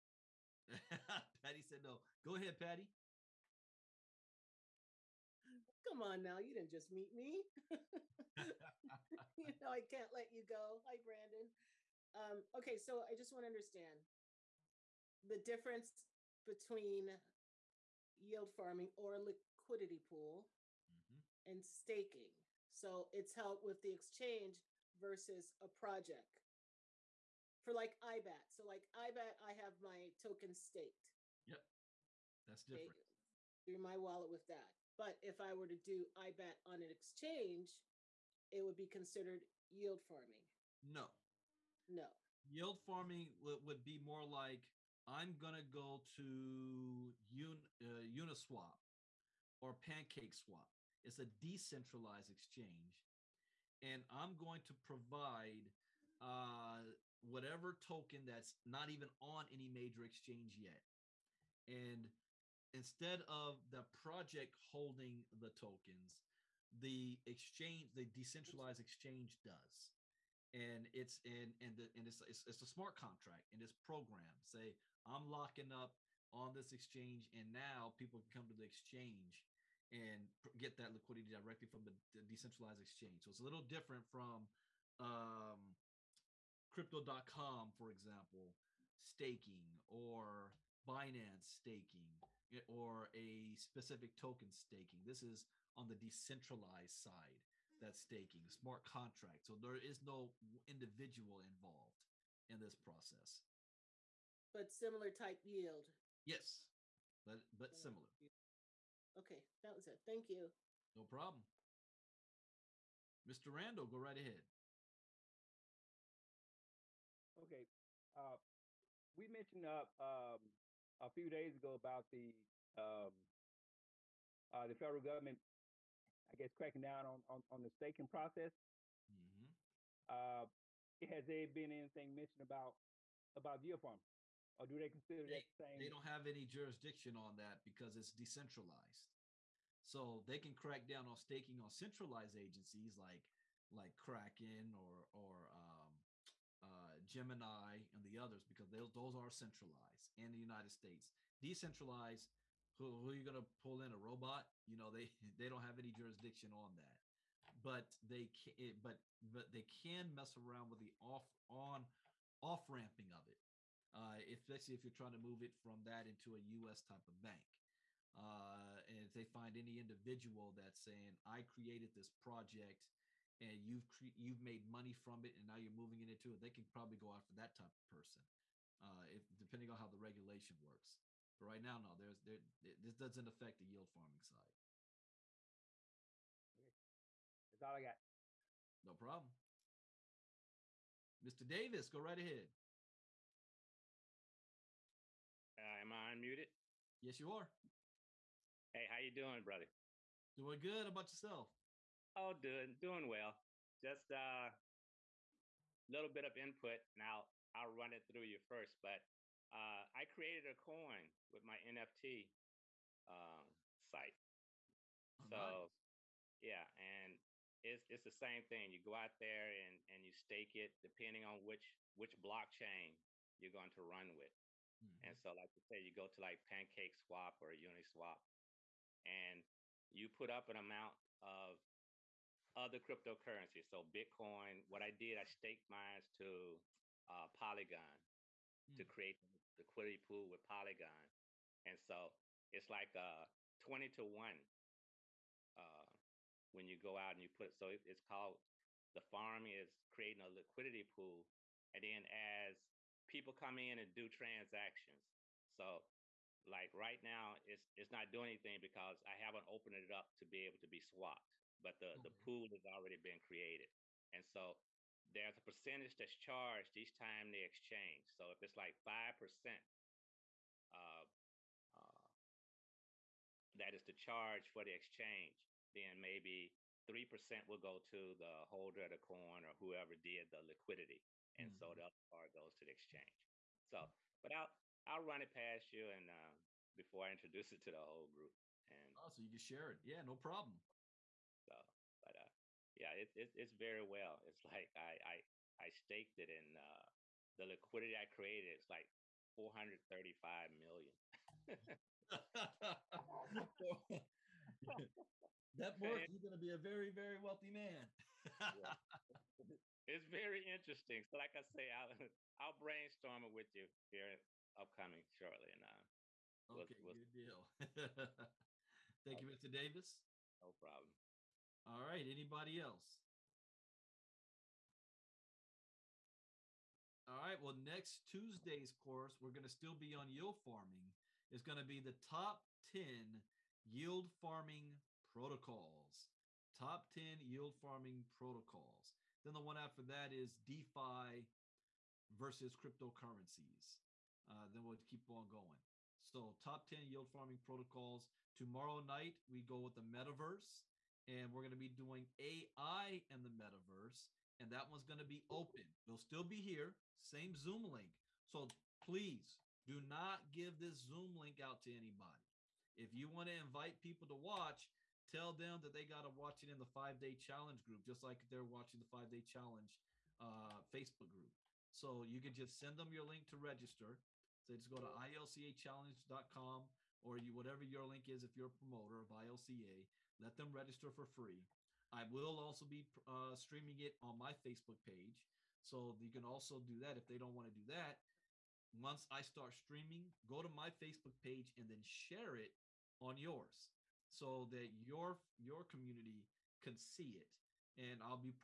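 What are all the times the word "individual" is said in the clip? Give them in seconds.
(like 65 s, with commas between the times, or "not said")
100 s, 169 s.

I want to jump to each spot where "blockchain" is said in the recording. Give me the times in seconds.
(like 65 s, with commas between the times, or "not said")
222 s.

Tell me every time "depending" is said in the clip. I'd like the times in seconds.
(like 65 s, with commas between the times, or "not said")
179 s, 220 s.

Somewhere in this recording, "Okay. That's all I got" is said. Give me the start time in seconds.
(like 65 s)
186 s.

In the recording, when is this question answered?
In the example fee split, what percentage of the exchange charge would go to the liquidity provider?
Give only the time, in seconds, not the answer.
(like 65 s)
276 s.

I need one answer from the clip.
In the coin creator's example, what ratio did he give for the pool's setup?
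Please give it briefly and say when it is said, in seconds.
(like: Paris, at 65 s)
20 to 1, at 243 s.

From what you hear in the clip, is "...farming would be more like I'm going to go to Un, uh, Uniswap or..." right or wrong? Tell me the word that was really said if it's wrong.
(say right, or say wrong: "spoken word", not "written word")
right.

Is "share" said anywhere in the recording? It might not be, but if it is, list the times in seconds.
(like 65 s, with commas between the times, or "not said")
289 s, 391 s.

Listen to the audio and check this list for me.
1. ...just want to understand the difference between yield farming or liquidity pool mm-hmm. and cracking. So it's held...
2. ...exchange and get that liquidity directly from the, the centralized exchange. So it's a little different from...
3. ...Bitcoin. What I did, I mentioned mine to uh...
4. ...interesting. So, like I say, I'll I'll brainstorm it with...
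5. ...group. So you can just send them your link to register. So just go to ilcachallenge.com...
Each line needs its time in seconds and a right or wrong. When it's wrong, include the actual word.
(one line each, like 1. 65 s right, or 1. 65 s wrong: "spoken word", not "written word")
1. 13 s wrong: "staking", not "cracking"
2. 78 s wrong: "decentralized", not "centralized"
3. 233 s wrong: "staked", not "mentioned"
4. 310 s right
5. 371 s right.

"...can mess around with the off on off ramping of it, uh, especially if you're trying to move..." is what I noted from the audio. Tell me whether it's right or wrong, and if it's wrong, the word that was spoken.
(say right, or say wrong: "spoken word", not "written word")
right.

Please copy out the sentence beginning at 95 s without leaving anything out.
This is on the decentralized side that's staking, smart contract.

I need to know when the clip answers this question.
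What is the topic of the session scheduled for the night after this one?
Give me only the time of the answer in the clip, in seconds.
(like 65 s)
352 s.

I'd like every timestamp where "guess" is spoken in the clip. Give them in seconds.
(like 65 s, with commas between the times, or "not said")
126 s.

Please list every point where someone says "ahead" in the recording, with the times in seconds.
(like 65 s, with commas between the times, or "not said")
2 s, 114 s, 192 s.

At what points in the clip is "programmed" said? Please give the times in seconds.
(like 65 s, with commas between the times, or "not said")
73 s.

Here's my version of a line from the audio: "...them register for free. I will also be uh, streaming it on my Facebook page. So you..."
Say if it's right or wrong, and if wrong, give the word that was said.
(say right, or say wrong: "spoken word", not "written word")
right.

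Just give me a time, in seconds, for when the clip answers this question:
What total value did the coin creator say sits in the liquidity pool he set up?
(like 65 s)
299 s.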